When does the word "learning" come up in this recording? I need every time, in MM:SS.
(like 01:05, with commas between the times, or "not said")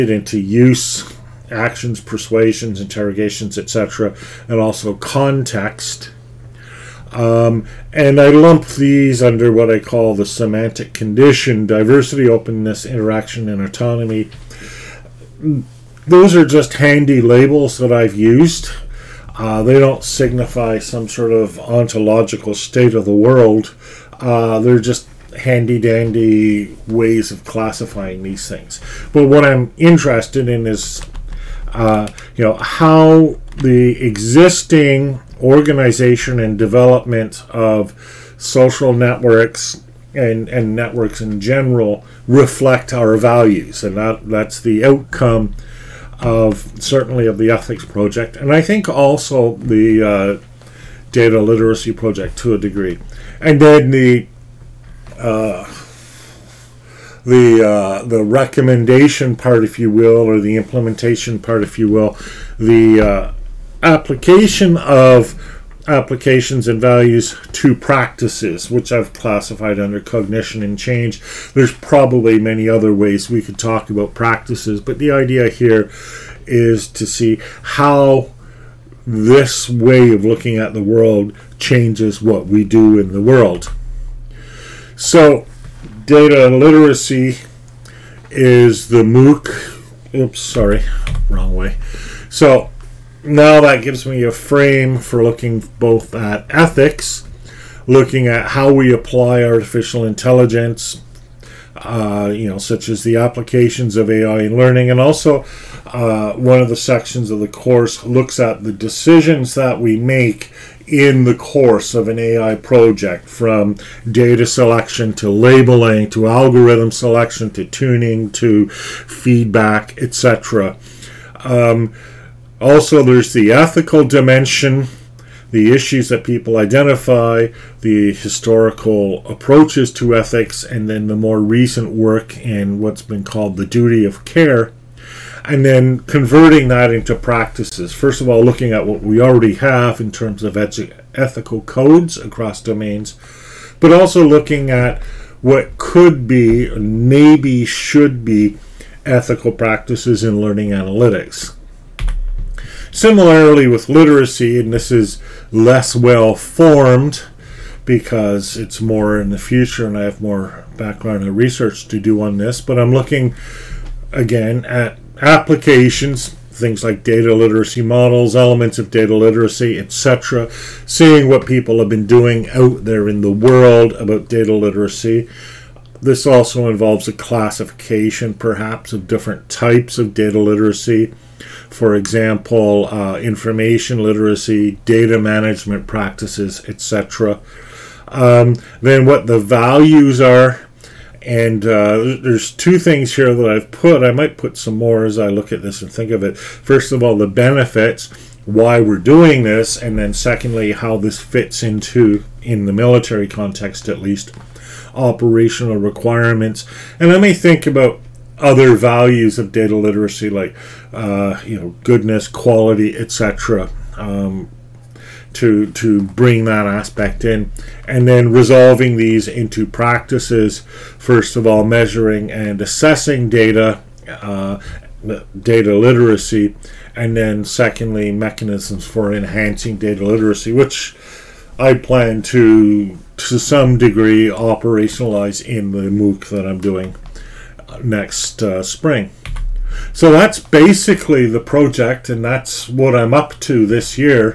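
01:44, 02:30.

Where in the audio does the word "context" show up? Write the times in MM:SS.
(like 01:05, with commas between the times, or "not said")
00:04, 03:23.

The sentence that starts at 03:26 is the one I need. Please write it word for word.
And I may think about other values of data literacy like, uh, you know, goodness, quality, etc.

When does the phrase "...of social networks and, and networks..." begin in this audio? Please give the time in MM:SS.
00:37.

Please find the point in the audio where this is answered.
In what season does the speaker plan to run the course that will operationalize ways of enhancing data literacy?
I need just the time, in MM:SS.
03:58.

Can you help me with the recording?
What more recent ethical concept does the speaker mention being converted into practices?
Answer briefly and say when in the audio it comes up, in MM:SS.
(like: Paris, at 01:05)
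duty of care, at 02:13.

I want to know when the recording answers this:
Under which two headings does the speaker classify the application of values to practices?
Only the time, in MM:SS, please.
01:09.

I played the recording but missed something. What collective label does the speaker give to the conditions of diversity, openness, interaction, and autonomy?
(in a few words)
semantic condition.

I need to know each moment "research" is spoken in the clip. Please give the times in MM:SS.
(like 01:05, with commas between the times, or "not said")
02:41.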